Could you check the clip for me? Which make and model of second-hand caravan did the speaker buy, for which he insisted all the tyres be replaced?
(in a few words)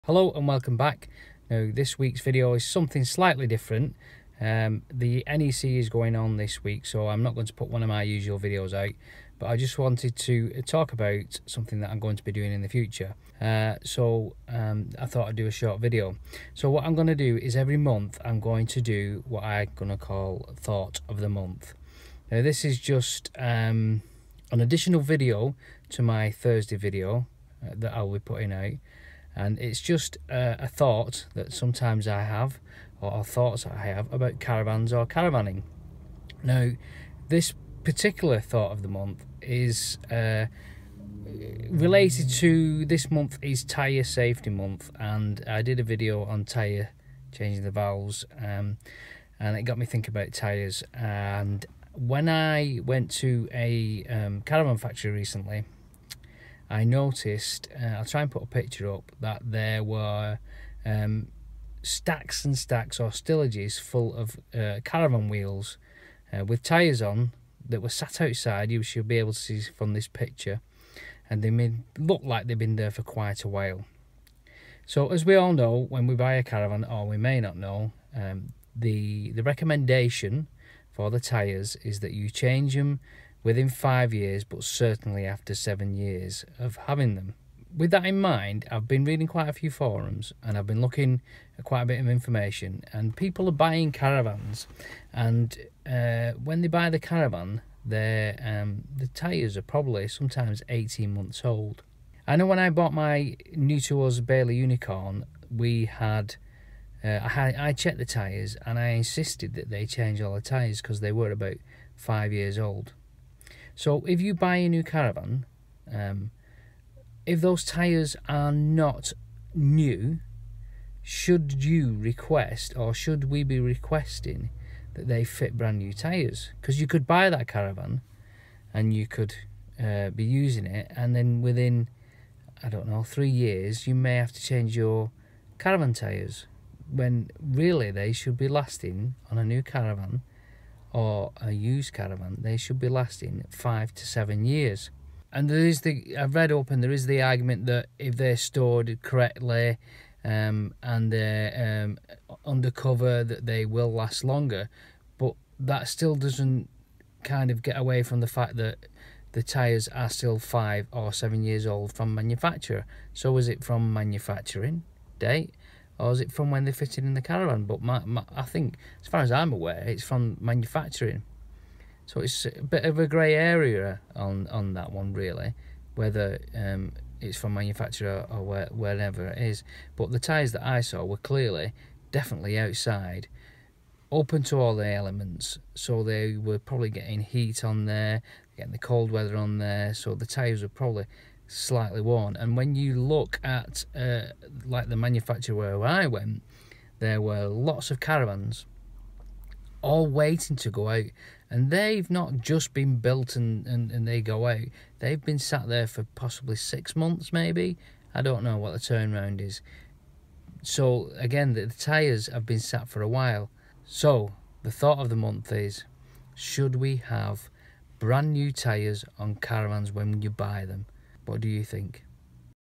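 Bailey Unicorn.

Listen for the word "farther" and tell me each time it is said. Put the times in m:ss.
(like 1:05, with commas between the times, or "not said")
not said.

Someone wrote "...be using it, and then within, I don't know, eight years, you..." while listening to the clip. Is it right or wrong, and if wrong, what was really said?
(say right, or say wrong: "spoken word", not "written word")
wrong: "three", not "eight".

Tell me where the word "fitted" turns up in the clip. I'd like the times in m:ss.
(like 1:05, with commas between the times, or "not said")
2:46.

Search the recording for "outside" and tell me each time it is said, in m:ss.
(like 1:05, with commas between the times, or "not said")
1:08, 3:02.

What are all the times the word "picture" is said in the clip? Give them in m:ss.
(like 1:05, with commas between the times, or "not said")
0:58, 1:10.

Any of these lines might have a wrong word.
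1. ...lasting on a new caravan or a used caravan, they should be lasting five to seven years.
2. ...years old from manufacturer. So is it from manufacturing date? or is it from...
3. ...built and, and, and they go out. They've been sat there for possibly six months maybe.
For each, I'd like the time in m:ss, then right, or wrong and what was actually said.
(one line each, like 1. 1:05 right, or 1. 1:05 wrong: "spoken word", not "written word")
1. 2:18 right
2. 2:41 right
3. 3:22 right.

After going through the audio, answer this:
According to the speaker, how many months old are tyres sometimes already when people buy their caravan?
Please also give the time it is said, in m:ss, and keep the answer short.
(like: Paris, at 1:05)
18 months, at 1:40.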